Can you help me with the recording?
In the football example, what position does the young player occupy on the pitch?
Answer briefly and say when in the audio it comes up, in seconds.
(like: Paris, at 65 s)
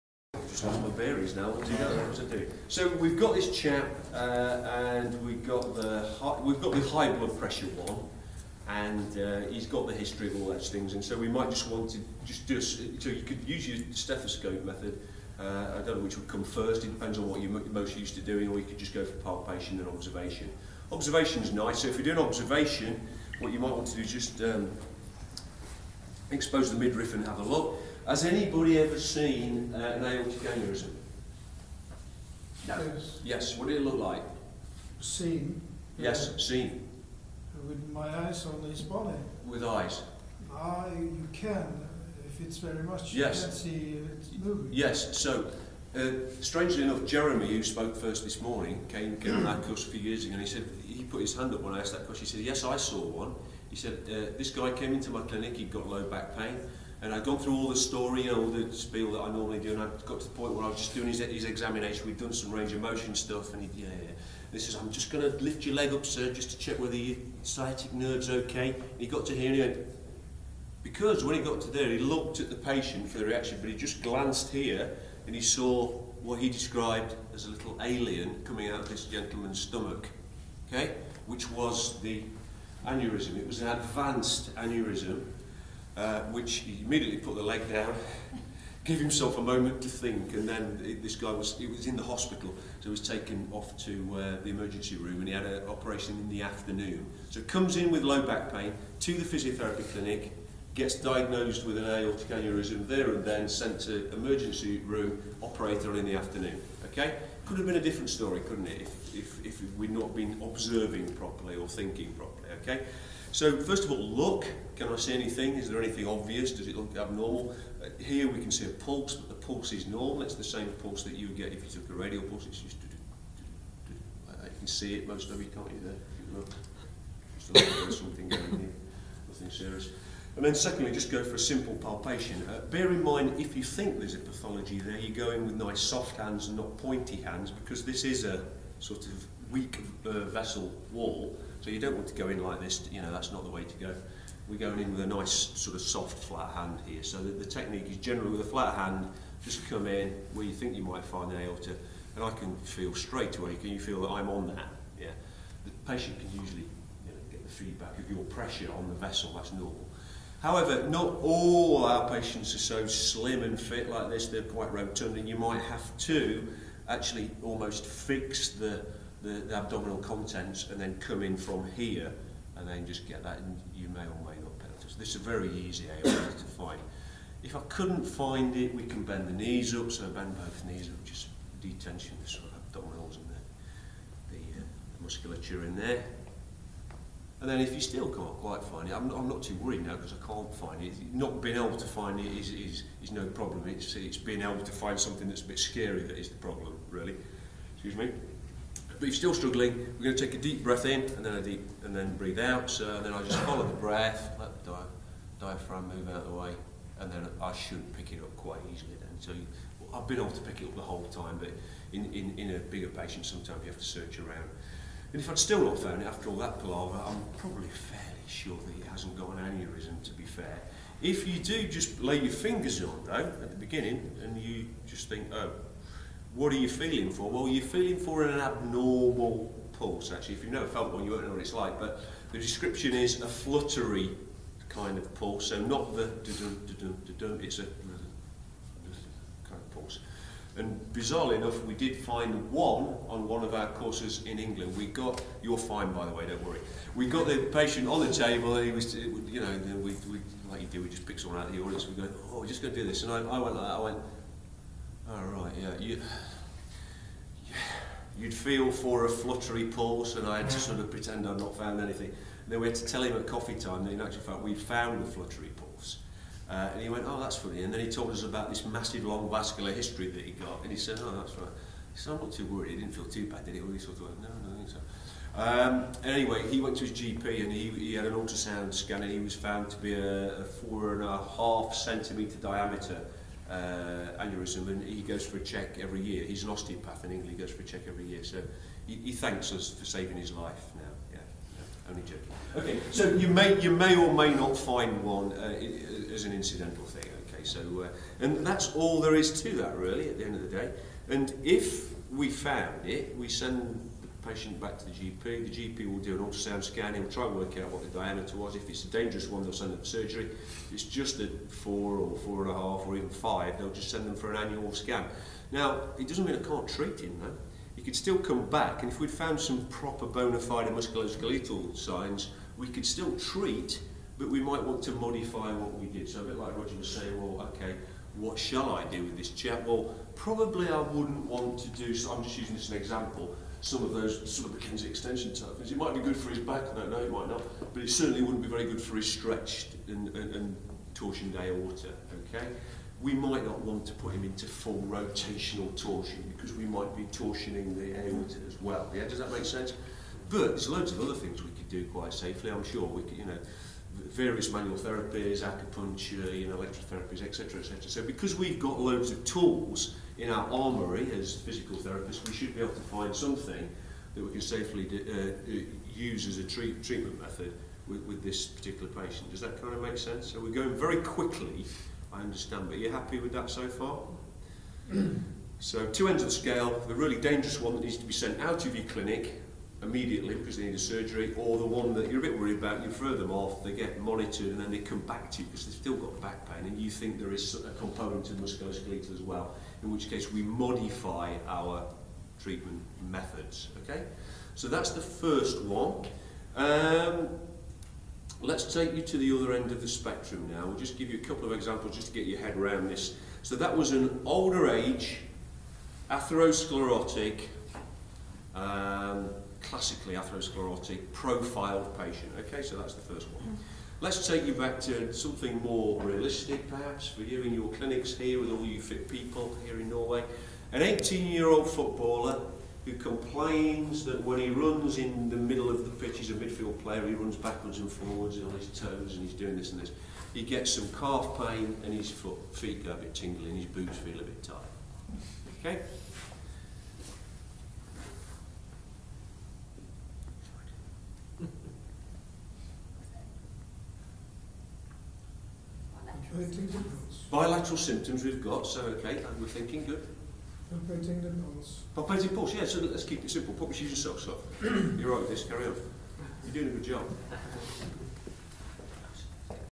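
midfield player, at 426 s.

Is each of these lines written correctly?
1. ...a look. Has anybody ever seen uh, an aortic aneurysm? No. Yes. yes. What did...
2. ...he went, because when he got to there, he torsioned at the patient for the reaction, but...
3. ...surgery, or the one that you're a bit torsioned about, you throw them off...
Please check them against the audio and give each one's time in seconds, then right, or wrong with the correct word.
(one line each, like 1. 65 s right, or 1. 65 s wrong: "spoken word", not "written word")
1. 27 s right
2. 69 s wrong: "looked", not "torsioned"
3. 380 s wrong: "worried", not "torsioned".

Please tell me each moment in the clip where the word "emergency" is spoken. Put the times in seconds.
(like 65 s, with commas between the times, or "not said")
94 s, 104 s.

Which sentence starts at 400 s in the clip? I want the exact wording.
We'll just give you a couple of examples just to get your head around this.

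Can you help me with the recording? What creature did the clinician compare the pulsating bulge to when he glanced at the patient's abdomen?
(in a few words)
little alien.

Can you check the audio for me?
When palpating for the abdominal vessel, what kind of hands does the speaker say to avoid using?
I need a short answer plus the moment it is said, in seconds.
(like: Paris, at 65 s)
pointy hands, at 136 s.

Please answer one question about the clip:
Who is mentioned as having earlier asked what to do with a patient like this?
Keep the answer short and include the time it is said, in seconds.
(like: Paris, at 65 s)
Roger, at 326 s.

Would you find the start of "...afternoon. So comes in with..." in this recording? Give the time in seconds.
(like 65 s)
96 s.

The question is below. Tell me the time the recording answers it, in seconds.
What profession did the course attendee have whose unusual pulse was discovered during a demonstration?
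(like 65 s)
286 s.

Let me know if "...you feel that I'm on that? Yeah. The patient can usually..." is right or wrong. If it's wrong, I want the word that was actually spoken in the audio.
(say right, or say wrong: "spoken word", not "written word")
right.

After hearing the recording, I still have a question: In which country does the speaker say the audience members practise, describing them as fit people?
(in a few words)
Norway.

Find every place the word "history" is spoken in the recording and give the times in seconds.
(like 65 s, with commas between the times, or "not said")
9 s, 269 s.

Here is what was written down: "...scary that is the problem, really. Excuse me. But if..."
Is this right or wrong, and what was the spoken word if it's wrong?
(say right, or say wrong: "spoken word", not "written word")
right.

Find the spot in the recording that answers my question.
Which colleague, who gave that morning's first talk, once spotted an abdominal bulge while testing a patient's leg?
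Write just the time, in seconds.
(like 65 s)
47 s.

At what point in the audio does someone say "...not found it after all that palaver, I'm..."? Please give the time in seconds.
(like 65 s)
215 s.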